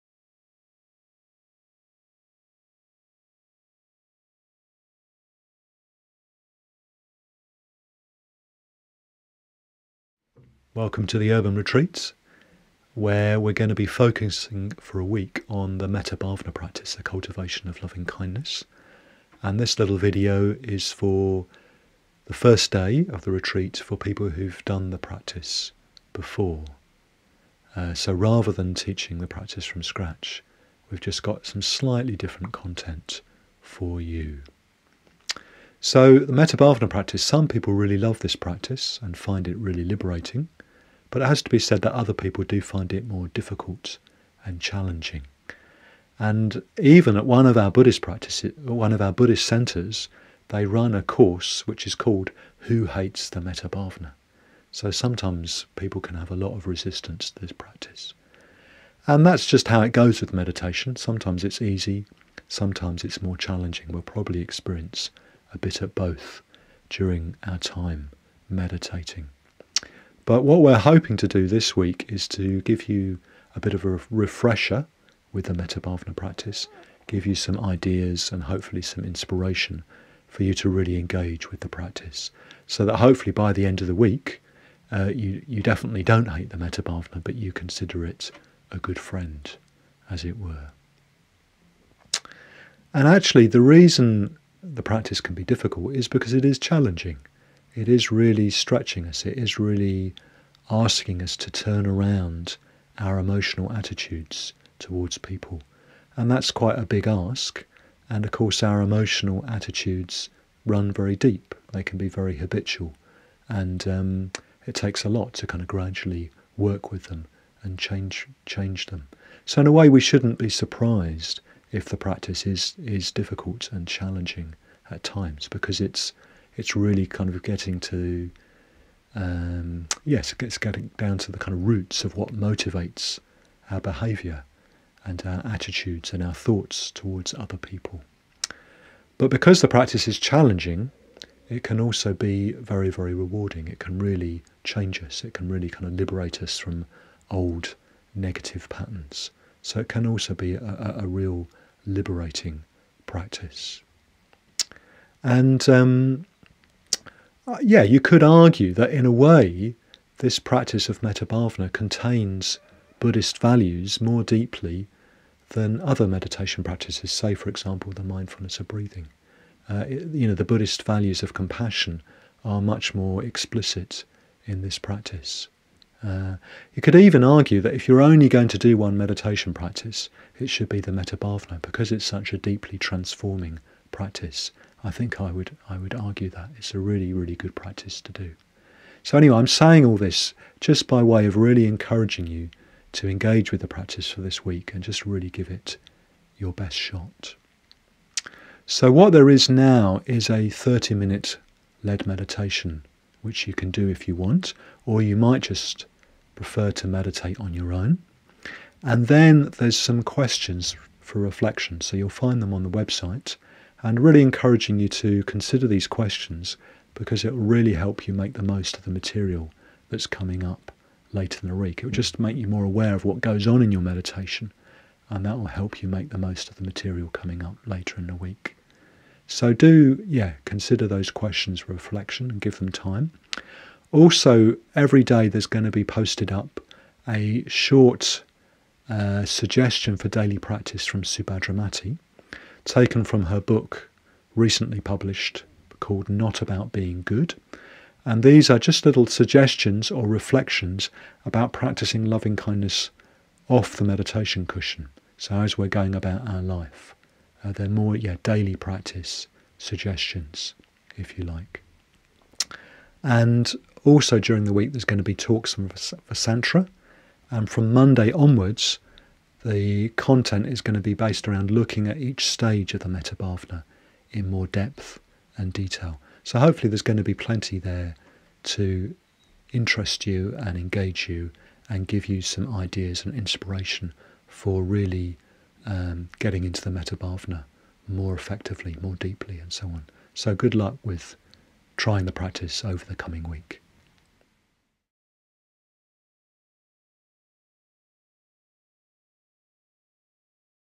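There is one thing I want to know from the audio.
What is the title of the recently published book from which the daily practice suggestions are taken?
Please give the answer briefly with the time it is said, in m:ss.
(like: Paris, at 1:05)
Not About Being Good, at 4:06.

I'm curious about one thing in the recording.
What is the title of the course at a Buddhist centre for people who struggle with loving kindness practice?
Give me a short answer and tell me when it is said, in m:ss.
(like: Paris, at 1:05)
Who Hates the Metta Bhavana, at 0:52.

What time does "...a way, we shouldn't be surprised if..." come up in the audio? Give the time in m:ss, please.
1:59.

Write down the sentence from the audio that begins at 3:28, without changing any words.
And then there's some questions for reflection.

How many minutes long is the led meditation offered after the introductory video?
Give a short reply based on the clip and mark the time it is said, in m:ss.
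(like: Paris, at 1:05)
30, at 3:20.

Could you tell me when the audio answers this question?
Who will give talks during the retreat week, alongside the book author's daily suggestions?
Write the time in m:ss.
4:25.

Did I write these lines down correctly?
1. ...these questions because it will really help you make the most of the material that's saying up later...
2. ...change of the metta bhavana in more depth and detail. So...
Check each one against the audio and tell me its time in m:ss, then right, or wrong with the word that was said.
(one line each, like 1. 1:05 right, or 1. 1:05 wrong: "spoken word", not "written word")
1. 3:35 wrong: "coming", not "saying"
2. 4:32 wrong: "stage", not "change".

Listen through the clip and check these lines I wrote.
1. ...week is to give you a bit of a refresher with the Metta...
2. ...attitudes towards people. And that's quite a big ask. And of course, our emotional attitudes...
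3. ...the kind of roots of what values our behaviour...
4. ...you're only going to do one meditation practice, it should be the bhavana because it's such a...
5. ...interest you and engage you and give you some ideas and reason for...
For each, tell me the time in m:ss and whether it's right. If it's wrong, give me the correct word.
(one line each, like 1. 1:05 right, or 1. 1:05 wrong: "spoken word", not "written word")
1. 1:11 right
2. 1:43 right
3. 2:11 wrong: "motivates", not "values"
4. 2:57 right
5. 4:39 wrong: "inspiration", not "reason".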